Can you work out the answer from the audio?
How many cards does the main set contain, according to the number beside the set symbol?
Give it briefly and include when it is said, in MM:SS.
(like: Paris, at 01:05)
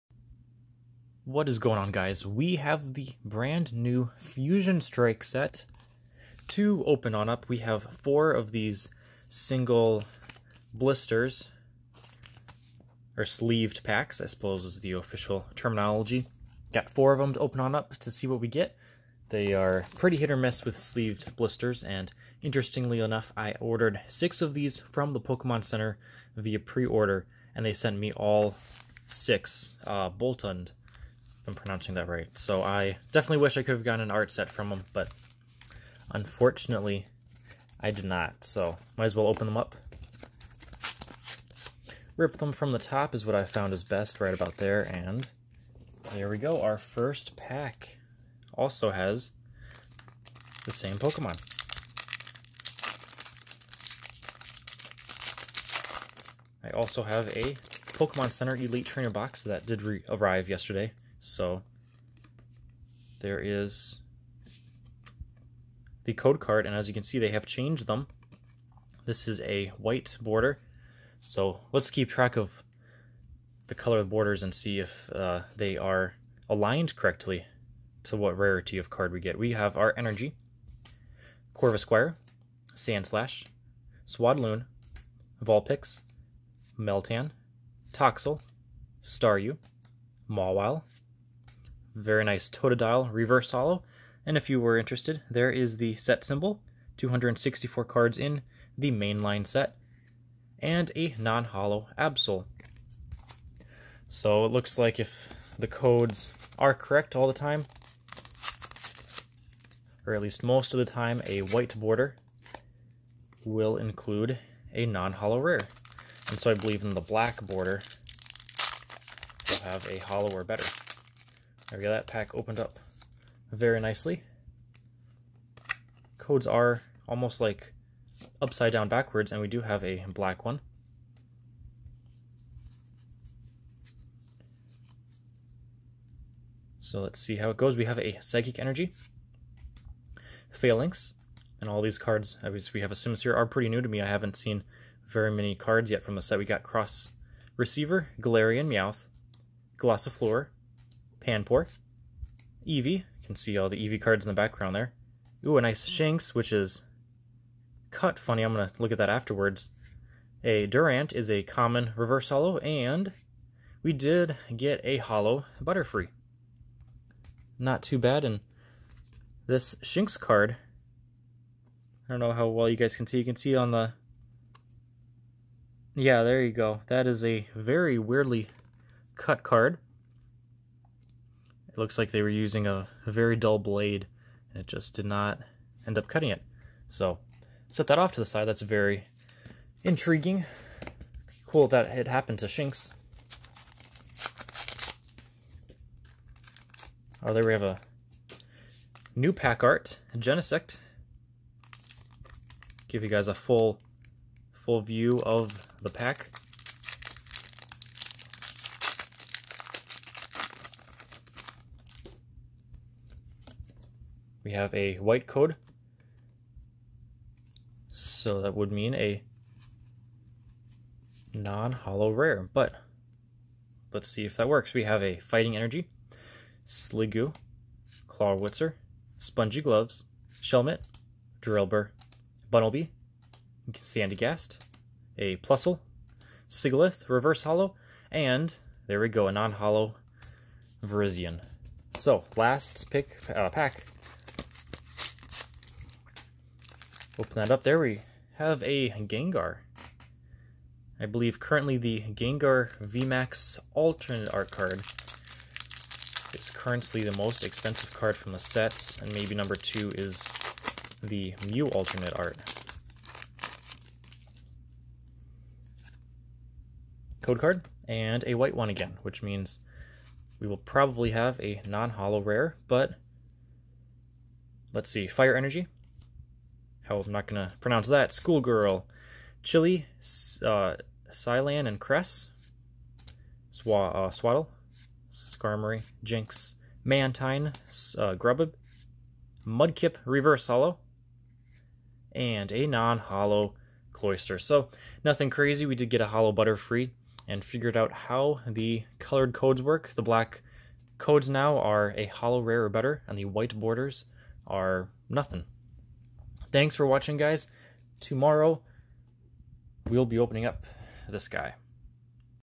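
264, at 01:36.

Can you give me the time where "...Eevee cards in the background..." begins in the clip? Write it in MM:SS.
02:33.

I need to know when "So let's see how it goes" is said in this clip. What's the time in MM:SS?
02:16.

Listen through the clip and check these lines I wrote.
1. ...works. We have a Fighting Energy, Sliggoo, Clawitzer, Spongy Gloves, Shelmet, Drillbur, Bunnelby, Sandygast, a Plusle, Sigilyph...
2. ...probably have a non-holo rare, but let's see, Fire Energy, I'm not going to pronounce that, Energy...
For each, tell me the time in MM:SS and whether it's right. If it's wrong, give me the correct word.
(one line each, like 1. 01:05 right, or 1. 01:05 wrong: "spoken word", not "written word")
1. 03:44 right
2. 04:30 wrong: "Schoolgirl", not "Energy".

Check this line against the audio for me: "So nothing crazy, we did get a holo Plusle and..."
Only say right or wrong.
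wrong.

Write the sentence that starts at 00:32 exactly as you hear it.
So I definitely wish I could have gotten an art set from them, but unfortunately I did not.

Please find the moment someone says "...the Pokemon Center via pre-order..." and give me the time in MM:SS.
00:25.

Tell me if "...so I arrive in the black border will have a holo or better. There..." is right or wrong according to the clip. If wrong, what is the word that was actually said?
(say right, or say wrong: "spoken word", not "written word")
wrong: "believe", not "arrive".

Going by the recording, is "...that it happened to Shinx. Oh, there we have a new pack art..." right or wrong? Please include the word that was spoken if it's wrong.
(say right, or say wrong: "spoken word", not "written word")
right.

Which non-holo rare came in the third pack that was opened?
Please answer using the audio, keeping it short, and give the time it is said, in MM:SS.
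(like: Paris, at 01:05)
Virizion, at 04:00.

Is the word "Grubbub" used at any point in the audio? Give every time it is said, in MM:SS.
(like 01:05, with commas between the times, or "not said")
04:48.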